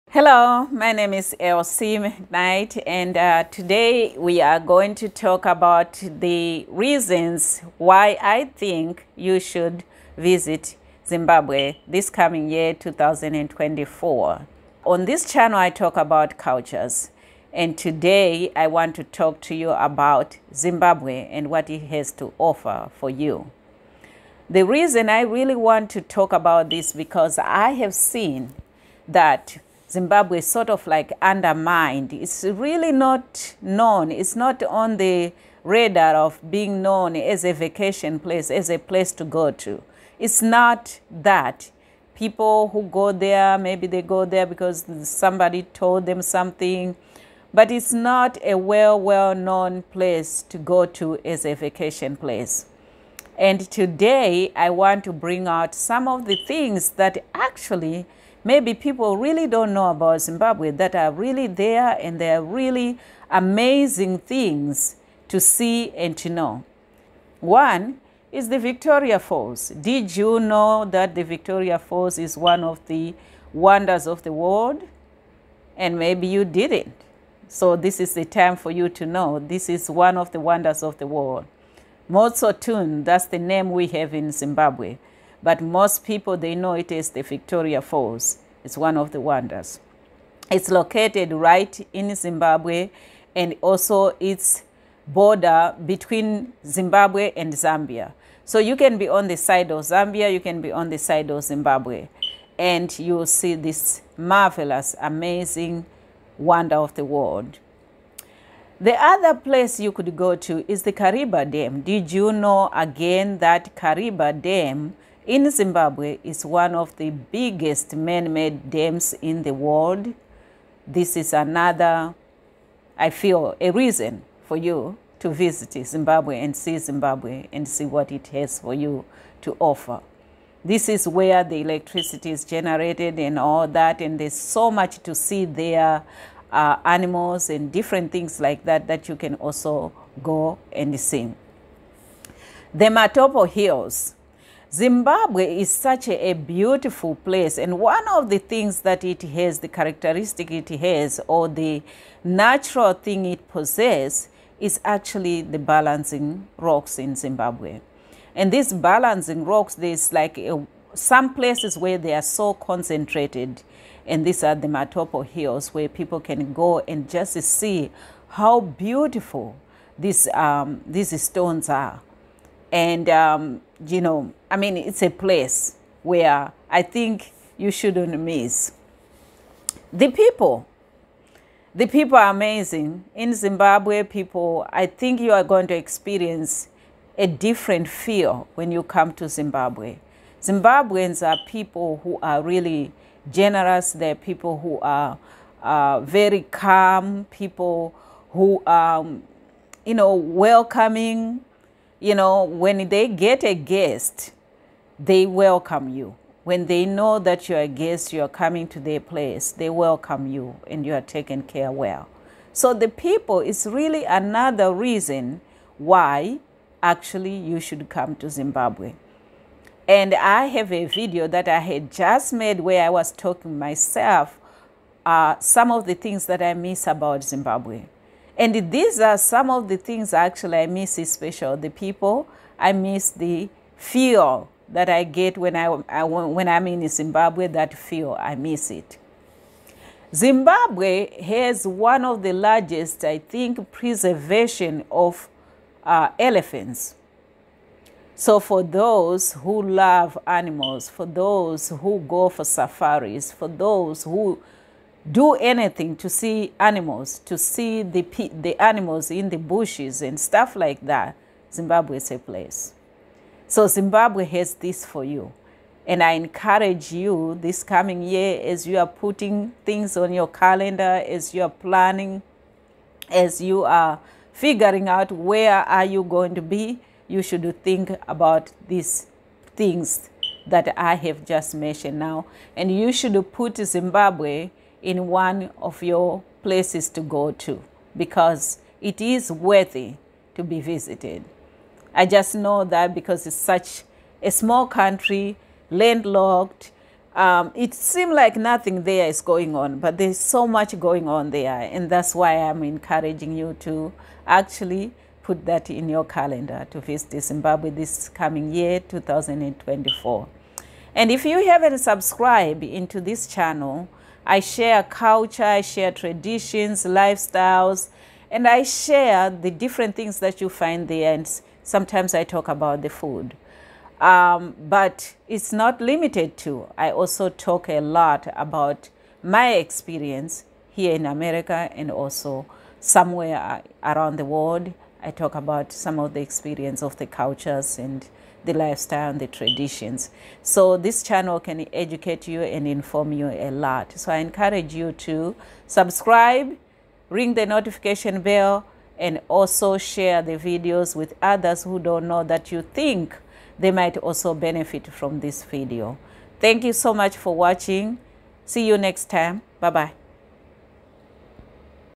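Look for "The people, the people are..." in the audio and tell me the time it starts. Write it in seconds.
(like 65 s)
179 s.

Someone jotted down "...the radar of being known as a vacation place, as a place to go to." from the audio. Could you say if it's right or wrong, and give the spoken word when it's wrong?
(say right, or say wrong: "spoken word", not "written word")
right.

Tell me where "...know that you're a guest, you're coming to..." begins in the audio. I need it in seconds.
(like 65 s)
206 s.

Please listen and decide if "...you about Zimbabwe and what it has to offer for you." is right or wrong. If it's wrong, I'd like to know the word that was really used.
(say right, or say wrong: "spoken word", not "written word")
right.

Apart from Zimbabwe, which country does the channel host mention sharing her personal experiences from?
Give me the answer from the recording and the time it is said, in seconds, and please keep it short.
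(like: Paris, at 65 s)
America, at 331 s.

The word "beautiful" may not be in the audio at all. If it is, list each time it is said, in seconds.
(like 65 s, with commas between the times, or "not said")
146 s, 168 s.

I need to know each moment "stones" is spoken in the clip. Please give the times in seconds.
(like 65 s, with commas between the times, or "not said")
171 s.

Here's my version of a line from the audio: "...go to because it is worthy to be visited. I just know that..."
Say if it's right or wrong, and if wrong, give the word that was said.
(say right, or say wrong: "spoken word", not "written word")
right.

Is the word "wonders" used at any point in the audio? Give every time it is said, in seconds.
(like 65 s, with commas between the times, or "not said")
73 s, 80 s, 89 s, 106 s.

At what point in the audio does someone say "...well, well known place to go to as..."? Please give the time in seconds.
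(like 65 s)
48 s.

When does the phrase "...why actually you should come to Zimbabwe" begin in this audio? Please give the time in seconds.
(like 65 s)
215 s.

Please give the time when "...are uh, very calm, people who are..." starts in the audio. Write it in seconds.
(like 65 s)
194 s.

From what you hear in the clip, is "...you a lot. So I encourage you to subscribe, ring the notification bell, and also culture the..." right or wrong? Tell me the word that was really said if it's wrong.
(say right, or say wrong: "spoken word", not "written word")
wrong: "share", not "culture".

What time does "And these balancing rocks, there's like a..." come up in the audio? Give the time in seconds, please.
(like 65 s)
158 s.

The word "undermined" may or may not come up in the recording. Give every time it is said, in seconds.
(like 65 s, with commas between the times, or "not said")
31 s.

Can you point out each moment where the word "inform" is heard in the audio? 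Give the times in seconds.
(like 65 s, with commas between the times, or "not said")
342 s.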